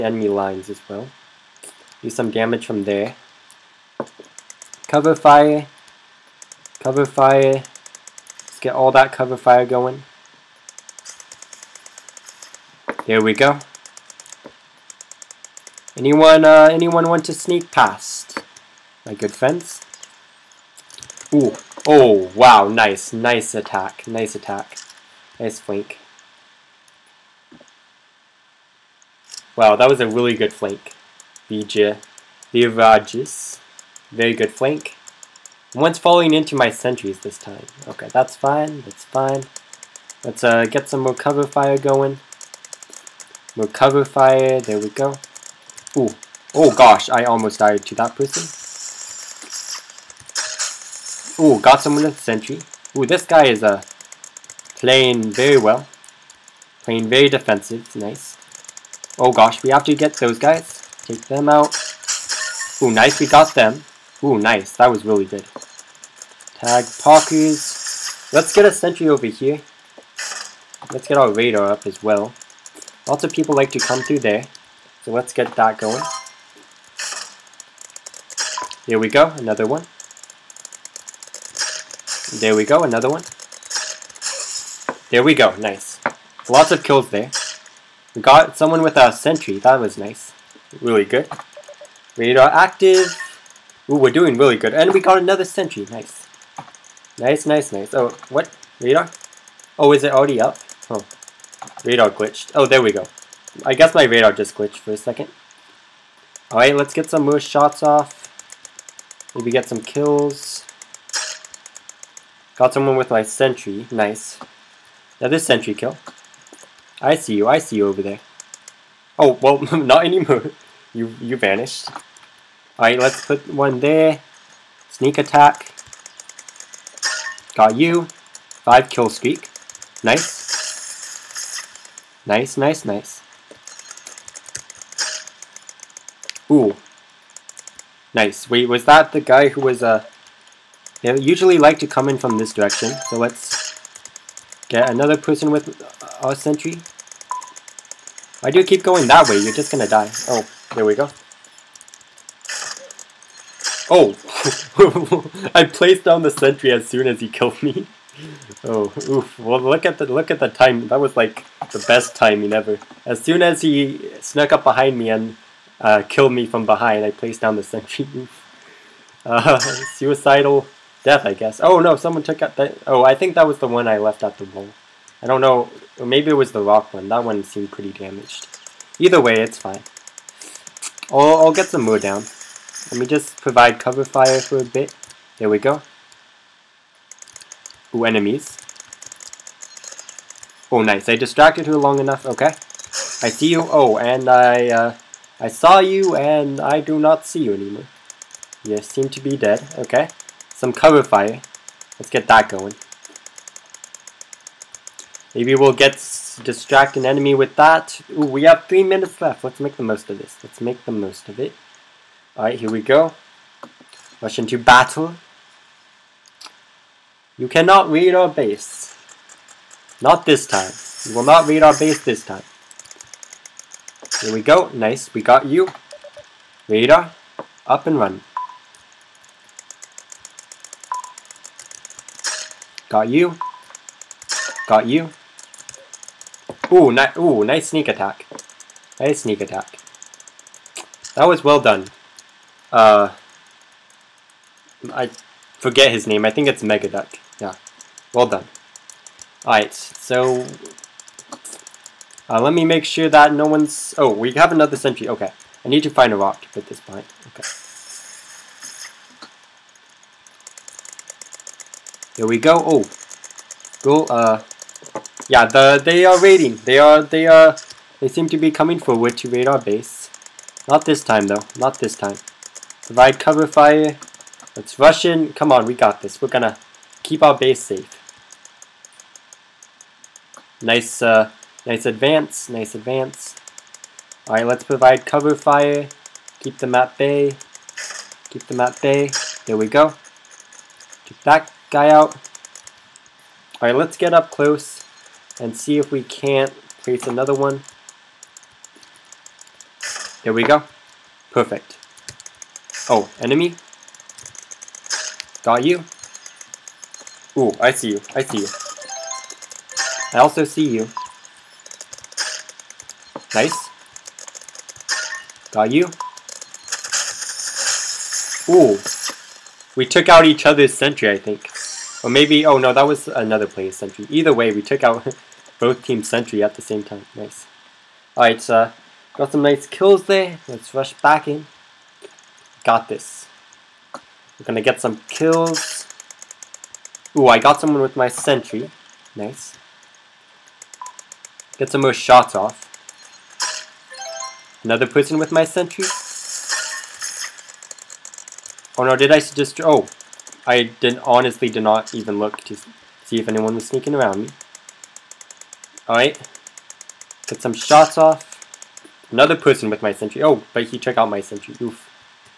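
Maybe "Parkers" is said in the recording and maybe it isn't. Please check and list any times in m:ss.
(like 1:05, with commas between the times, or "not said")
1:07.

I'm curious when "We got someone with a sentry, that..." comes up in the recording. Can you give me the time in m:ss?
1:28.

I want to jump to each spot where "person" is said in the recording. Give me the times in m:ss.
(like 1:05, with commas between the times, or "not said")
0:48, 2:25, 5:44, 5:59.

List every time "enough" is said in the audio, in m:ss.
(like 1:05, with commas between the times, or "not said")
3:11.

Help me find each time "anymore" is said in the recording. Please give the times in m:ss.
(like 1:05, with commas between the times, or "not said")
2:00, 3:17.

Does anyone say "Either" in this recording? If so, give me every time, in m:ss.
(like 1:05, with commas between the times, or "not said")
2:58, 5:24.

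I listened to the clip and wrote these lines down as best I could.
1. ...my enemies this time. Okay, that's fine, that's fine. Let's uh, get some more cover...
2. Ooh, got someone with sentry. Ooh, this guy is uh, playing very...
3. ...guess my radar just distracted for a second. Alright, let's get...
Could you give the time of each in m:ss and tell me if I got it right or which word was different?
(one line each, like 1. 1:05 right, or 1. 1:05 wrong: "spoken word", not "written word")
1. 0:36 wrong: "sentries", not "enemies"
2. 0:51 right
3. 1:43 wrong: "glitched", not "distracted".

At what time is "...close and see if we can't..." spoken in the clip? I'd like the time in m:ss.
4:54.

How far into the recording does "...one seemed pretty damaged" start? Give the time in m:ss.
2:57.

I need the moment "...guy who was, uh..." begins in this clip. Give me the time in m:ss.
2:19.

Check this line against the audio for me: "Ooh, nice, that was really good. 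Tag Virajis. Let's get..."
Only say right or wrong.
wrong.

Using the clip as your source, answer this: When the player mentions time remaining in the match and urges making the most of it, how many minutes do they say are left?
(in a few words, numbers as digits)
3.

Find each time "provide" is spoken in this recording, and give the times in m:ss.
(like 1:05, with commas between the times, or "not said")
3:03, 4:32, 4:44.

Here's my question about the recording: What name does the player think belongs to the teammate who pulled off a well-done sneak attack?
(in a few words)
Megaduck.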